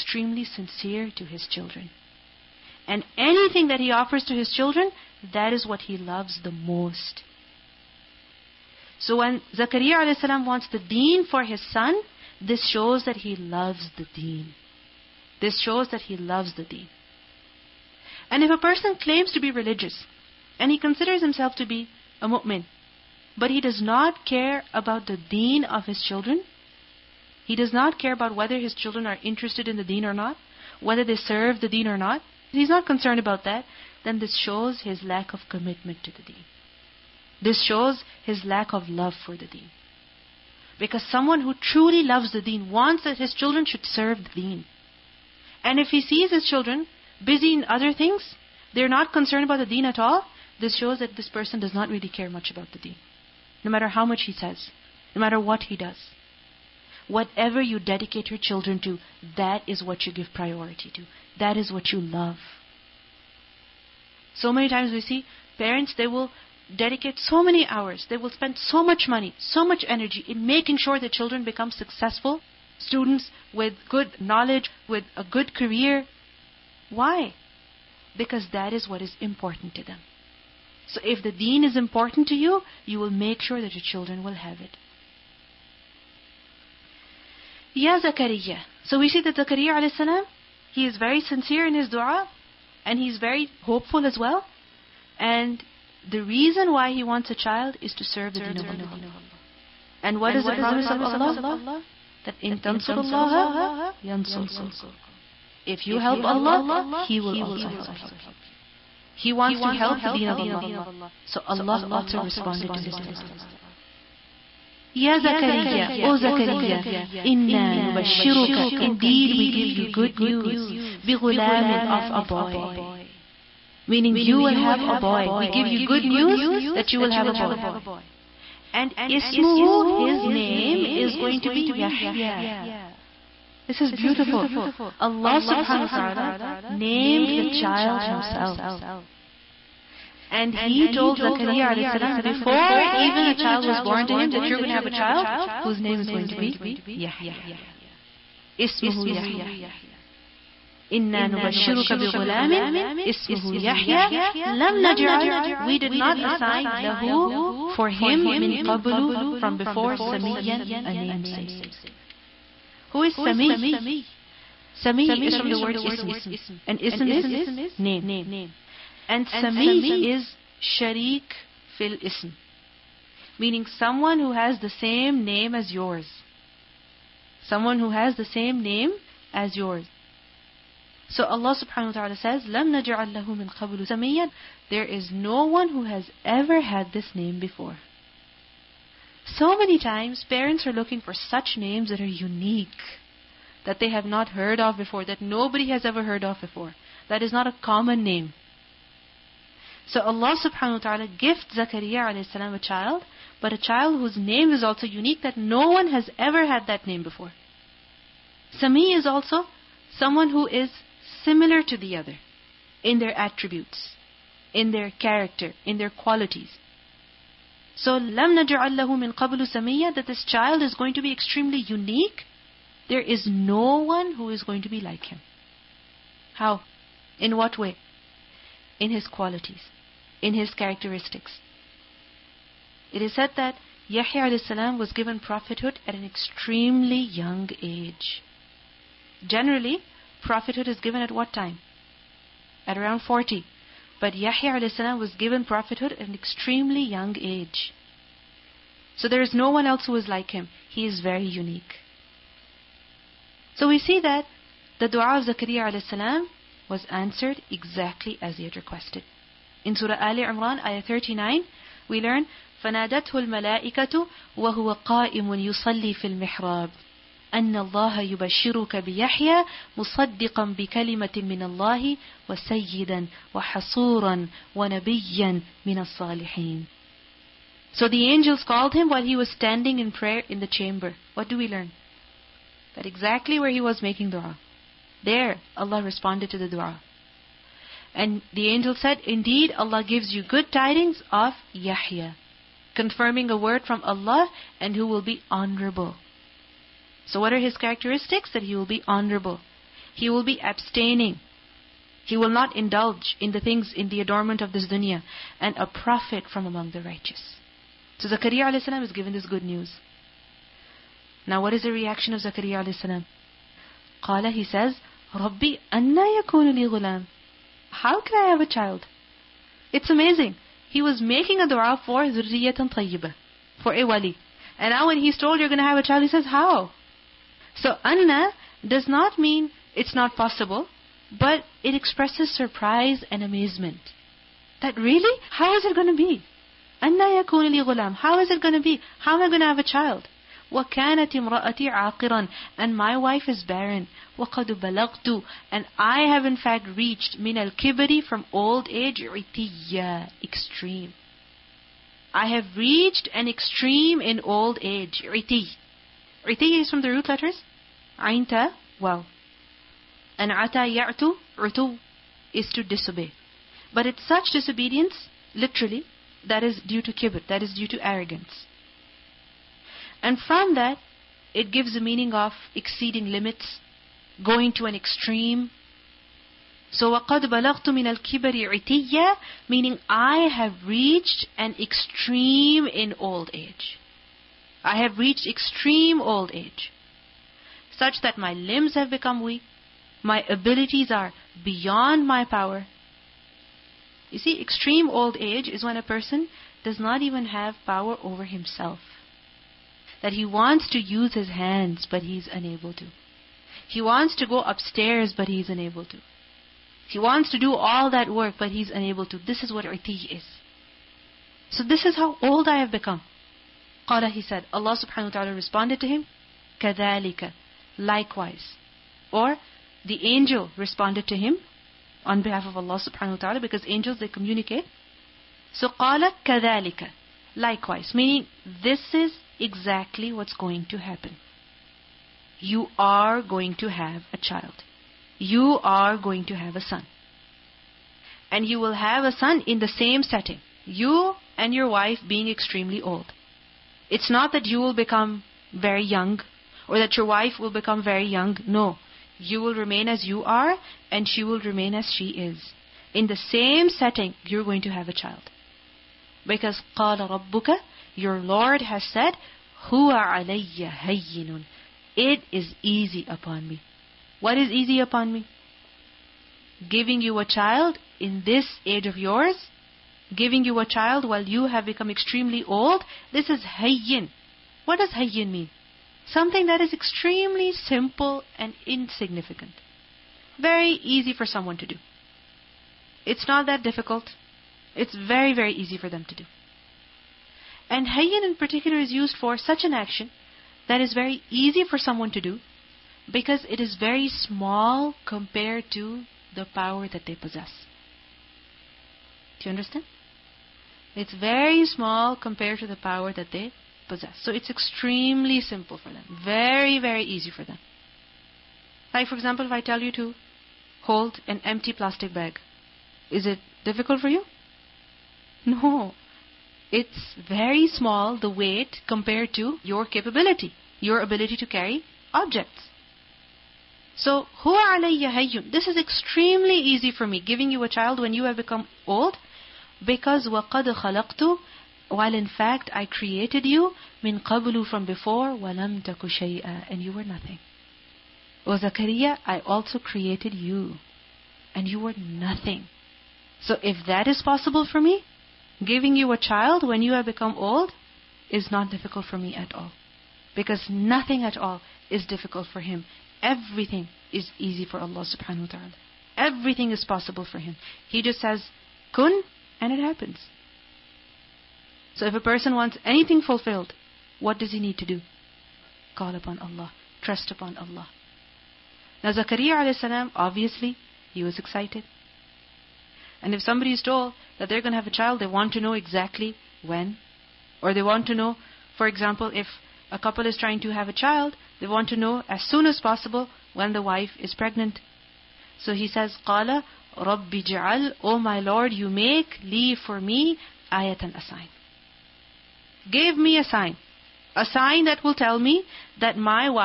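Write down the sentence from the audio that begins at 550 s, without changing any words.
Because nothing at all is difficult for him.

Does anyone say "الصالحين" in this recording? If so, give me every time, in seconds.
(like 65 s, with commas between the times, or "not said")
275 s.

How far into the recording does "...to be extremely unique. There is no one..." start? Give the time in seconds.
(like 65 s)
220 s.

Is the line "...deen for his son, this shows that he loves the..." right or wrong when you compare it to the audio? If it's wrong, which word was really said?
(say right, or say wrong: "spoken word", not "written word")
right.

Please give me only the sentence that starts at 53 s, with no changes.
No matter how much he says, no matter what he does.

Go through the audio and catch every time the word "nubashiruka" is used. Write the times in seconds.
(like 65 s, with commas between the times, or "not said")
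117 s, 151 s.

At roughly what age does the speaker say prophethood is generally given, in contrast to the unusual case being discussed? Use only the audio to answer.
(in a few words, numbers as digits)
40.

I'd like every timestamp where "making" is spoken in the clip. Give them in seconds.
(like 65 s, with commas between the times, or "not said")
70 s, 283 s, 320 s.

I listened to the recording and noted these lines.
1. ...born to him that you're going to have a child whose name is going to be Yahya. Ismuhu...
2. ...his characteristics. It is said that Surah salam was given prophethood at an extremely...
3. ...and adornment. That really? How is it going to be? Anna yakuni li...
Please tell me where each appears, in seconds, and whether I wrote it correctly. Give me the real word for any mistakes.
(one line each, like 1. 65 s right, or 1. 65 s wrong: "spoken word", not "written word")
1. 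143 s right
2. 230 s wrong: "Yahya", not "Surah"
3. 333 s wrong: "amazement", not "adornment".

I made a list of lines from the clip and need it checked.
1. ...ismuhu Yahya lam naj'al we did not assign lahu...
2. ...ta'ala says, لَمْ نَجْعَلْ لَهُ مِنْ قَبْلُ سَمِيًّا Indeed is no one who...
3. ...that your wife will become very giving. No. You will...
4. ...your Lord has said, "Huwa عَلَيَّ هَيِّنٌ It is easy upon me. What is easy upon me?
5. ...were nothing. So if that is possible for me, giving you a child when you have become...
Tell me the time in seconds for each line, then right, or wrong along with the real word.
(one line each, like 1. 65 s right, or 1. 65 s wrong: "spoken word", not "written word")
1. 153 s right
2. 182 s wrong: "There", not "Indeed"
3. 446 s wrong: "young", not "giving"
4. 457 s right
5. 541 s right.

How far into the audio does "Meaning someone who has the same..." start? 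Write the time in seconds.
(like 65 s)
173 s.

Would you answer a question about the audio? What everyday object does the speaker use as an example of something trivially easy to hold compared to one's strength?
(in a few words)
empty plastic bag.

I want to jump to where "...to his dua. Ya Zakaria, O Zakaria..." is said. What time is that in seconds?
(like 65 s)
112 s.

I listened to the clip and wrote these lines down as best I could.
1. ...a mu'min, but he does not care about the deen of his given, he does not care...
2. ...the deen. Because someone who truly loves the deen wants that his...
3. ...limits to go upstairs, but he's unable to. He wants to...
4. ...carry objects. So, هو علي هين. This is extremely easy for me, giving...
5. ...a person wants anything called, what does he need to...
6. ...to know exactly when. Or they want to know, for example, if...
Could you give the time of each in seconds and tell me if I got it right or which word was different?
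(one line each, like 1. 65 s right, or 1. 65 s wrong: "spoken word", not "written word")
1. 22 s wrong: "children", not "given"
2. 39 s right
3. 403 s wrong: "wants", not "limits"
4. 521 s right
5. 562 s wrong: "fulfilled", not "called"
6. 575 s right.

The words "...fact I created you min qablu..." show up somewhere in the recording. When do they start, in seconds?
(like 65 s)
532 s.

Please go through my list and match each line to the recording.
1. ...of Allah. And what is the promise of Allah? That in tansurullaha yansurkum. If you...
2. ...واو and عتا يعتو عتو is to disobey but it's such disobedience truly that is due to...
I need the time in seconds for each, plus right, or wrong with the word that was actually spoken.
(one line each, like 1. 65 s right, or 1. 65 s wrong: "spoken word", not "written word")
1. 98 s right
2. 358 s wrong: "literally", not "truly".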